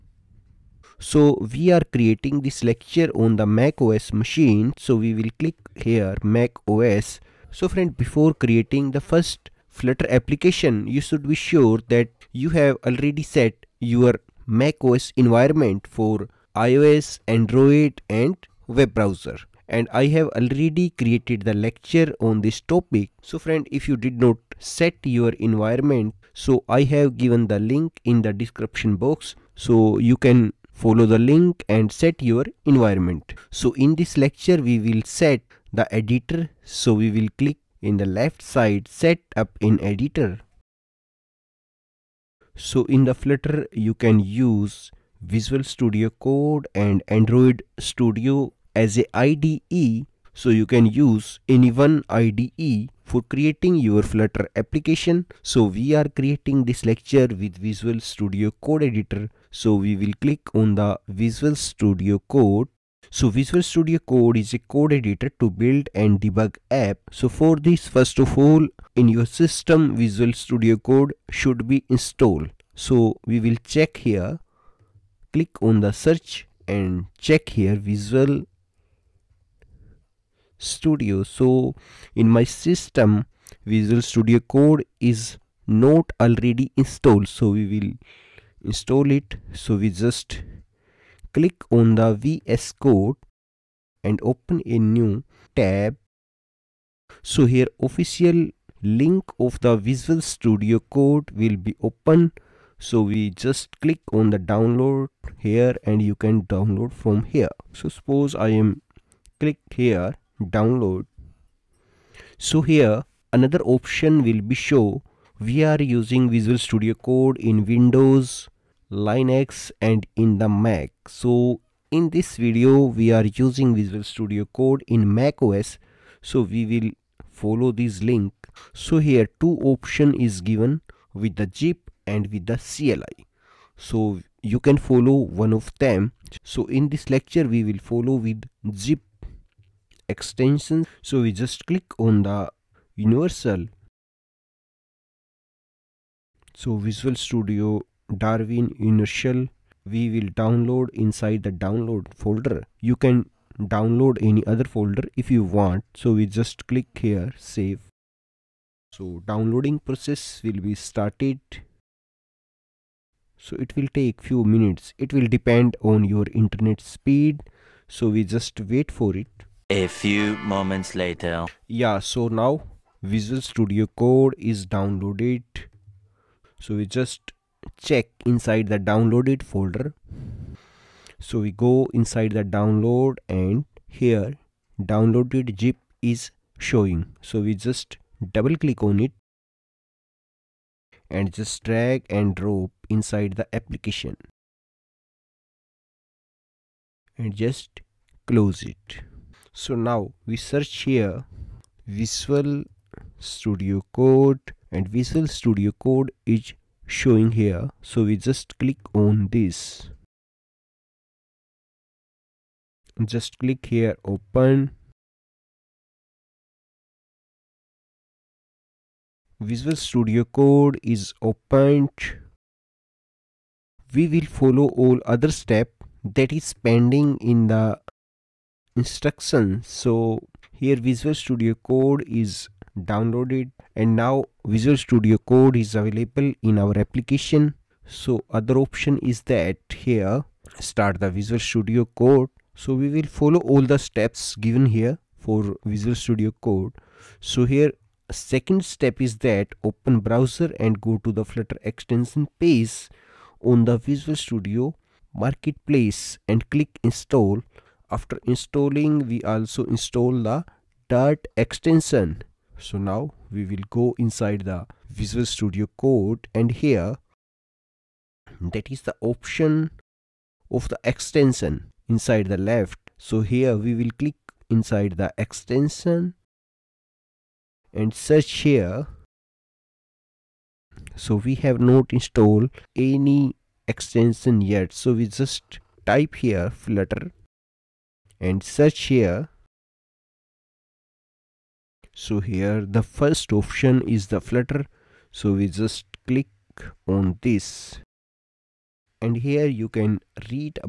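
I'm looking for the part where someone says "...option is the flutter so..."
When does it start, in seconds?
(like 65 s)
293 s.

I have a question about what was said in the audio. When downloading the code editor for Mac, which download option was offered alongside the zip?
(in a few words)
CLI.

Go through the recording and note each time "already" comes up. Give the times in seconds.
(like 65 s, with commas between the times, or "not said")
12 s, 20 s, 86 s.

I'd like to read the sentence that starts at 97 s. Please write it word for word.
So here official link of the Visual Studio Code will be open.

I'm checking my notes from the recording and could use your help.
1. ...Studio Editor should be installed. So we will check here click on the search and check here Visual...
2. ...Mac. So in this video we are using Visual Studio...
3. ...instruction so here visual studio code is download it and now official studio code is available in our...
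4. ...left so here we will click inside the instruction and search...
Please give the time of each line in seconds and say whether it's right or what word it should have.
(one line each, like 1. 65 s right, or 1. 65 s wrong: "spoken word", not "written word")
1. 70 s wrong: "Code", not "Editor"
2. 120 s right
3. 228 s wrong: "visual", not "official"
4. 272 s wrong: "extension", not "instruction".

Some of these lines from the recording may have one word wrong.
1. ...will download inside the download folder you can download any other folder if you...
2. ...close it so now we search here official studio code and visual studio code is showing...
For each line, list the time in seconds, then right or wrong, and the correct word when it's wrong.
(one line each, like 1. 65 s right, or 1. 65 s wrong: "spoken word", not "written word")
1. 150 s right
2. 198 s wrong: "visual", not "official".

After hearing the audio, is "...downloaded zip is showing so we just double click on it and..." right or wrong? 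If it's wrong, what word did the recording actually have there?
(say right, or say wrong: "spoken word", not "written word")
right.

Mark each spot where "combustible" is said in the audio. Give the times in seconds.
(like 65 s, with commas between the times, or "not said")
not said.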